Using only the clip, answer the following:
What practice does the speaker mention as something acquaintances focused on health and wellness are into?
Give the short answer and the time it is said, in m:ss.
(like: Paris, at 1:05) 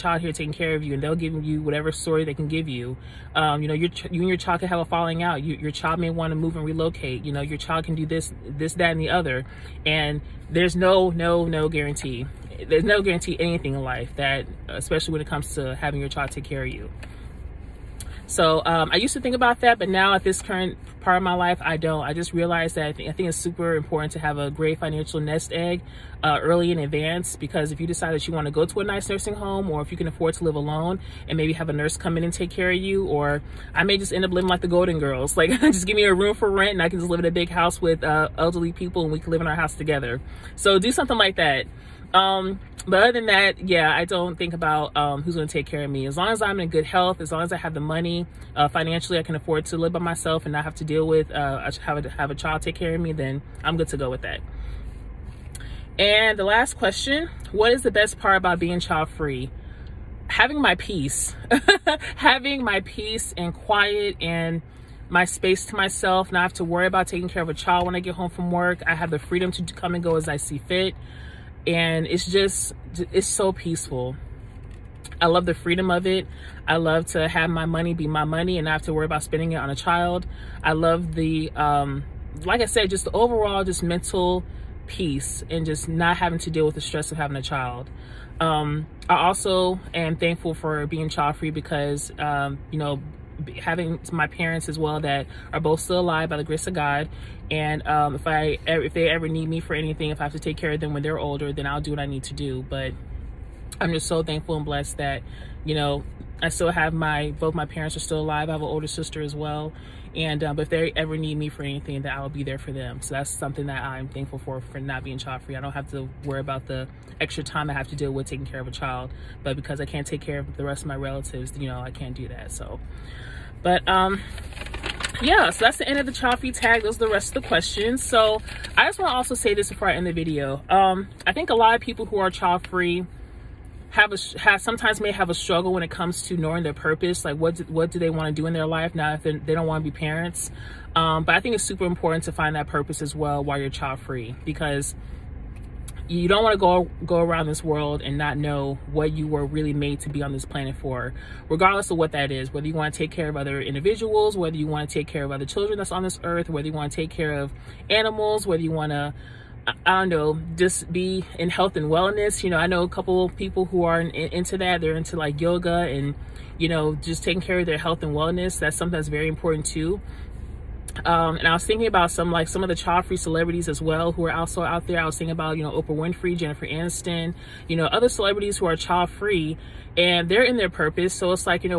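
Yoga, at 2:45.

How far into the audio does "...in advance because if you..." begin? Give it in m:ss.
0:26.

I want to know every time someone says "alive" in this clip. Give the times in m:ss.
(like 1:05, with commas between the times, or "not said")
1:35, 1:48.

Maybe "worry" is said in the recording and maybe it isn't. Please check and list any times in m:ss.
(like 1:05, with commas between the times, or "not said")
1:06, 1:18, 1:56.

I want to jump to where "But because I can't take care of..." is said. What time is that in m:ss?
1:59.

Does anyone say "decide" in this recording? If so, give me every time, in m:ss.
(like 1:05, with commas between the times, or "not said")
0:27.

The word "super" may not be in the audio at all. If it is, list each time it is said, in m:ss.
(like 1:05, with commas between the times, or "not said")
0:23, 2:21.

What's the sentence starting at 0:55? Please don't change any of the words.
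And the last question, what is the best part about being child free?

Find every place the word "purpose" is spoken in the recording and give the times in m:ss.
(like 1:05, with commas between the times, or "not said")
2:16, 2:22, 3:00.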